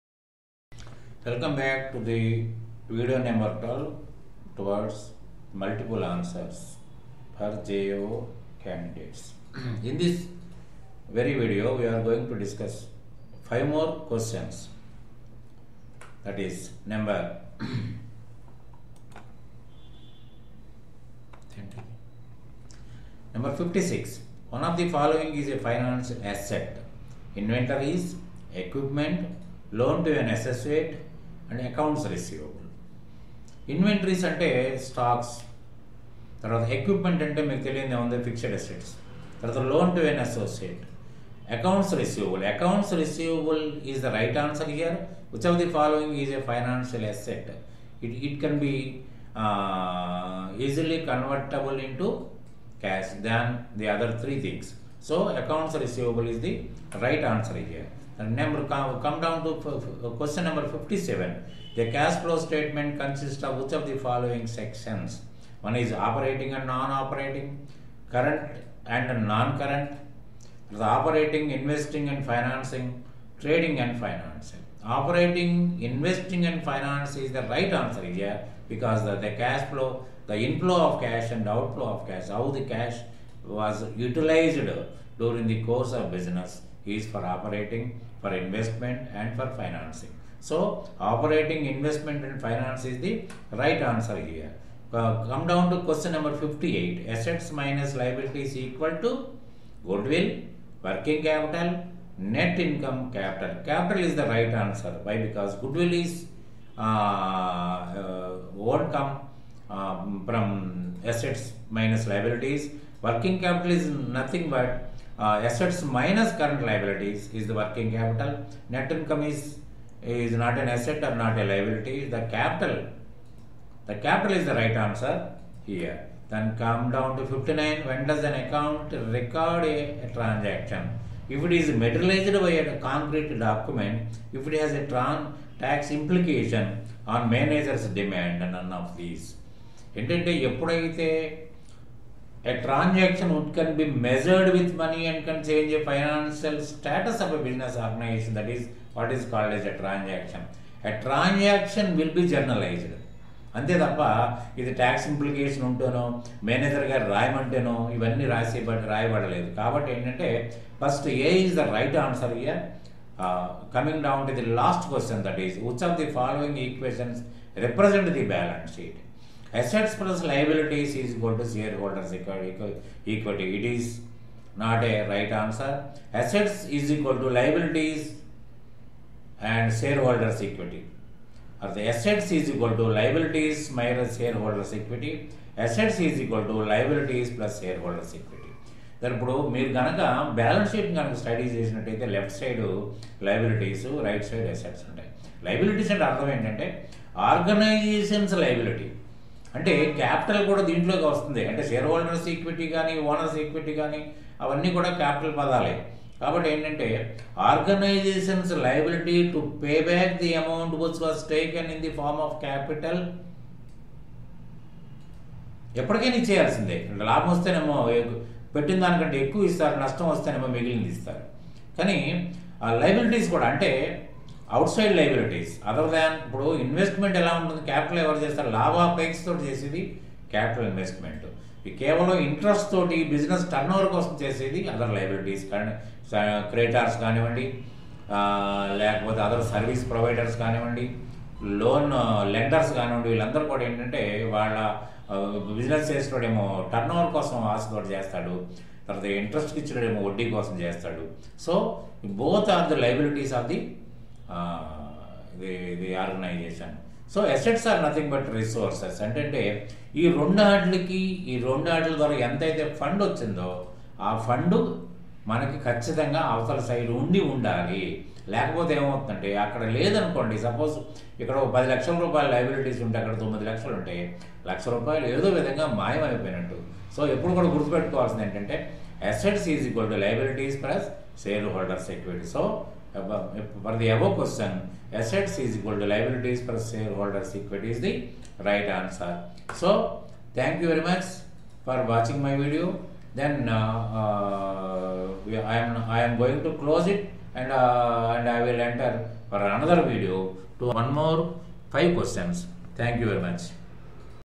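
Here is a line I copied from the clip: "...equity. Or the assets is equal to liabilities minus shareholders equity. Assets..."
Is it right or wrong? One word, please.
right.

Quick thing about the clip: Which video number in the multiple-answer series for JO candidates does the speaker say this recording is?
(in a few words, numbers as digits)
12.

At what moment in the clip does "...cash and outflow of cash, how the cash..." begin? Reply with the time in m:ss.
1:21.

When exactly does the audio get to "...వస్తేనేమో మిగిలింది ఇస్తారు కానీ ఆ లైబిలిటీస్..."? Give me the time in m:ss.
3:40.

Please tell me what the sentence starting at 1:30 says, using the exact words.
So, operating, investment and finance is the right answer here.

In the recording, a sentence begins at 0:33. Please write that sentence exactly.
Inventories and stocks, equipment and the the on fixed assets, loan to an associate, accounts receivable.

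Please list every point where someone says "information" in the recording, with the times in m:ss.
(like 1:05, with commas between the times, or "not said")
not said.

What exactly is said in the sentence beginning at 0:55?
So accounts receivable is the right answer here.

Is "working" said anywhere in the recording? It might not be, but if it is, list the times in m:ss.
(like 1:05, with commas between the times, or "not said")
1:40, 1:53, 1:57.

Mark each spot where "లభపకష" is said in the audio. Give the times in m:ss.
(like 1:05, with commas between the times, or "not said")
3:48.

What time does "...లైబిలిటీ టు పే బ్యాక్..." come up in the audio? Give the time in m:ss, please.
3:28.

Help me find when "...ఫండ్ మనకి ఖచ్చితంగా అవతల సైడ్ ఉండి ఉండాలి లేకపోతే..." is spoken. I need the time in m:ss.
4:24.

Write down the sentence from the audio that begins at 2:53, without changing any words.
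It is not a right answer.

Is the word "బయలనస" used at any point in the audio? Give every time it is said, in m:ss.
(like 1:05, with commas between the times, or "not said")
2:48, 3:10.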